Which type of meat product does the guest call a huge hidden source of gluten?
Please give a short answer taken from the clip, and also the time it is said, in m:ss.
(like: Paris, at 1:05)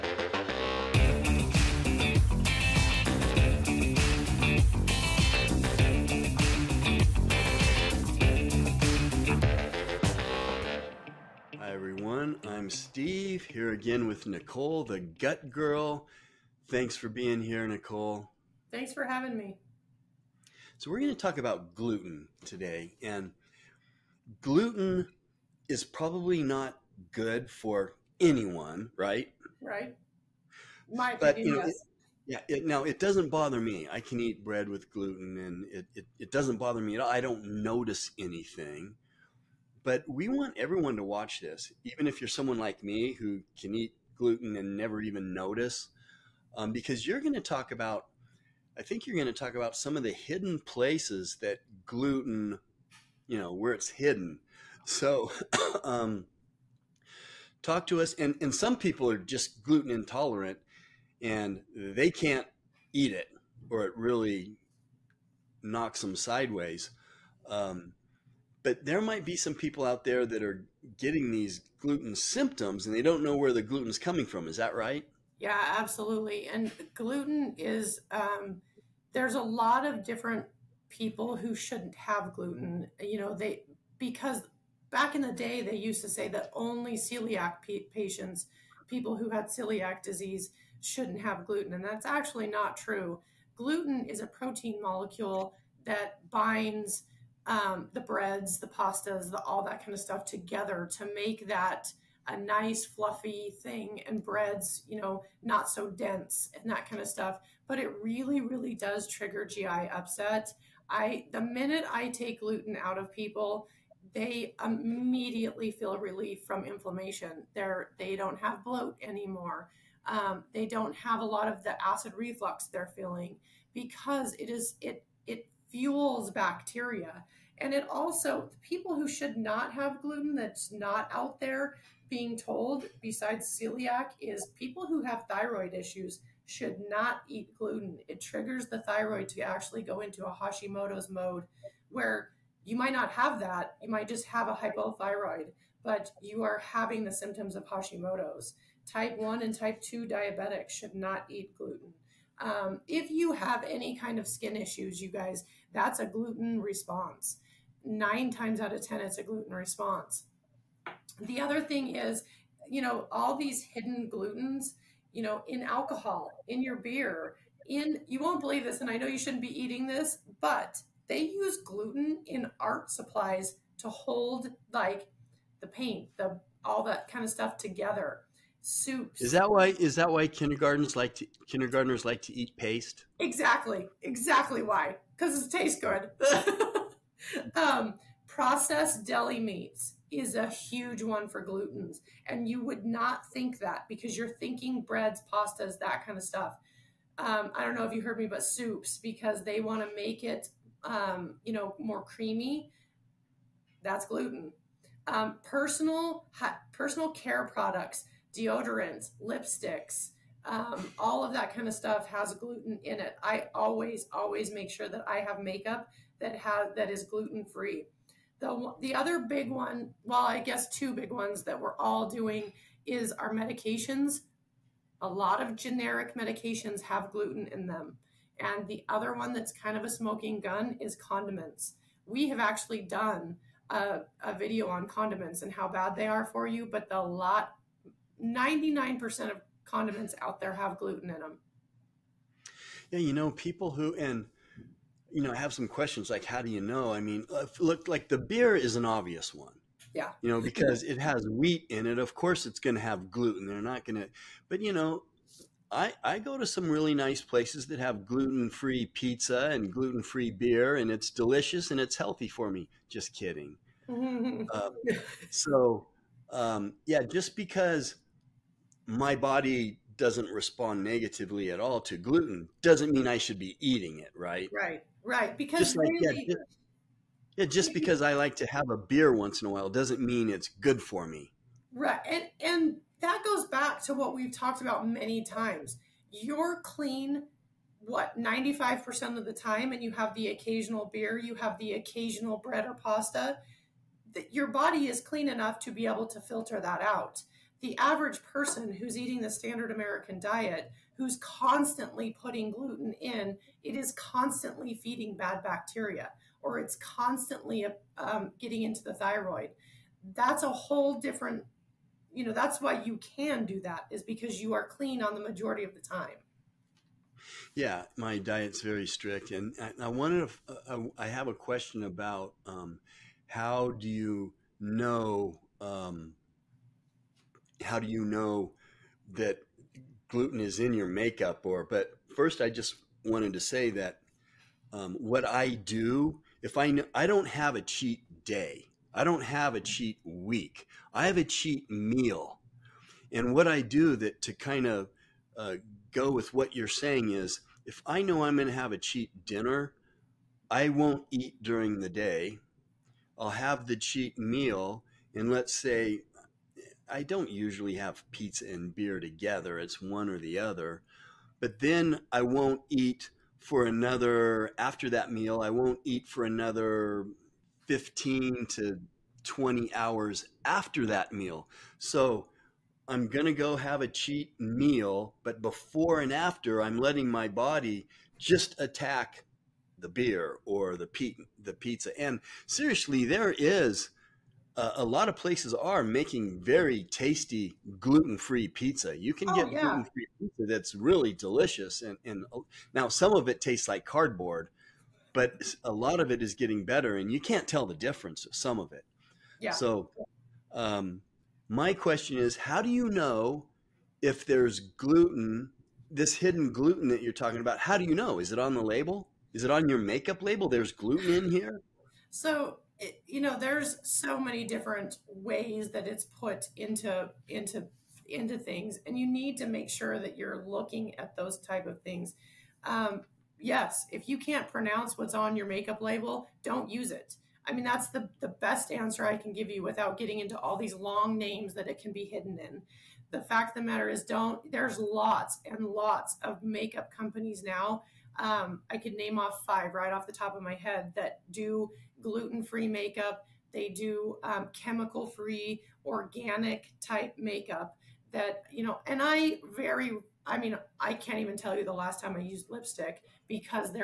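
processed deli meats, at 3:08.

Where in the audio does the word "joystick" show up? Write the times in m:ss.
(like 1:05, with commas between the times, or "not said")
not said.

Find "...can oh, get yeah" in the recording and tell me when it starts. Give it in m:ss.
6:29.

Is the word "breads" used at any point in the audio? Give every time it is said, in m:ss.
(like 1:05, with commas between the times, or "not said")
0:34, 1:38, 1:44, 3:14, 4:52.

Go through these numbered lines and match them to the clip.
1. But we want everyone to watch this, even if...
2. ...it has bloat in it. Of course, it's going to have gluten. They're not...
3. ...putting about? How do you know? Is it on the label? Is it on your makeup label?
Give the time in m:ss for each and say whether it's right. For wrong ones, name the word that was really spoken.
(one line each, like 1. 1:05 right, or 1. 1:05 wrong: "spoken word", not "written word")
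1. 0:39 right
2. 4:10 wrong: "wheat", not "bloat"
3. 6:47 wrong: "talking", not "putting".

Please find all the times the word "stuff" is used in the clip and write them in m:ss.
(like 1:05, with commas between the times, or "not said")
1:39, 1:47, 2:57, 3:16, 3:31.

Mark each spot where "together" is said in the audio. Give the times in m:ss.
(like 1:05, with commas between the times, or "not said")
1:40, 2:57, 5:58.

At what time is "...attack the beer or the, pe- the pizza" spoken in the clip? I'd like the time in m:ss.
6:18.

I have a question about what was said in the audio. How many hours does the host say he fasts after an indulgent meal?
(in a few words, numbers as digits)
15 to 20 hours.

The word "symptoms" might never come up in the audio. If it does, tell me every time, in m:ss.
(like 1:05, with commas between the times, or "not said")
1:12, 2:27.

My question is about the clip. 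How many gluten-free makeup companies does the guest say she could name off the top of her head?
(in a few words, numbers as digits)
5.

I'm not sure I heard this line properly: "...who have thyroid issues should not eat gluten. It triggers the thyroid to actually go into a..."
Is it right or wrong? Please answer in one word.
right.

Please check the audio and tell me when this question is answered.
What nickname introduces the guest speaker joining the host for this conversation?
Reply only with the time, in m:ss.
0:14.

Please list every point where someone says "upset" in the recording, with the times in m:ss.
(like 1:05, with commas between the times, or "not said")
1:49.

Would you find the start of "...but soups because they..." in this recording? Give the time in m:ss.
3:18.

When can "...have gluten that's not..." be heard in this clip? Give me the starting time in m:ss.
2:09.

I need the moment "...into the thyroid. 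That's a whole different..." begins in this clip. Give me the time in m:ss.
5:08.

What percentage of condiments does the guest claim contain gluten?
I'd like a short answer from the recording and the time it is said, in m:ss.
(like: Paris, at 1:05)
99%, at 3:58.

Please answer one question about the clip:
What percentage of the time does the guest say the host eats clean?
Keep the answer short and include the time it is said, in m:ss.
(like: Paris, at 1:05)
95%, at 4:48.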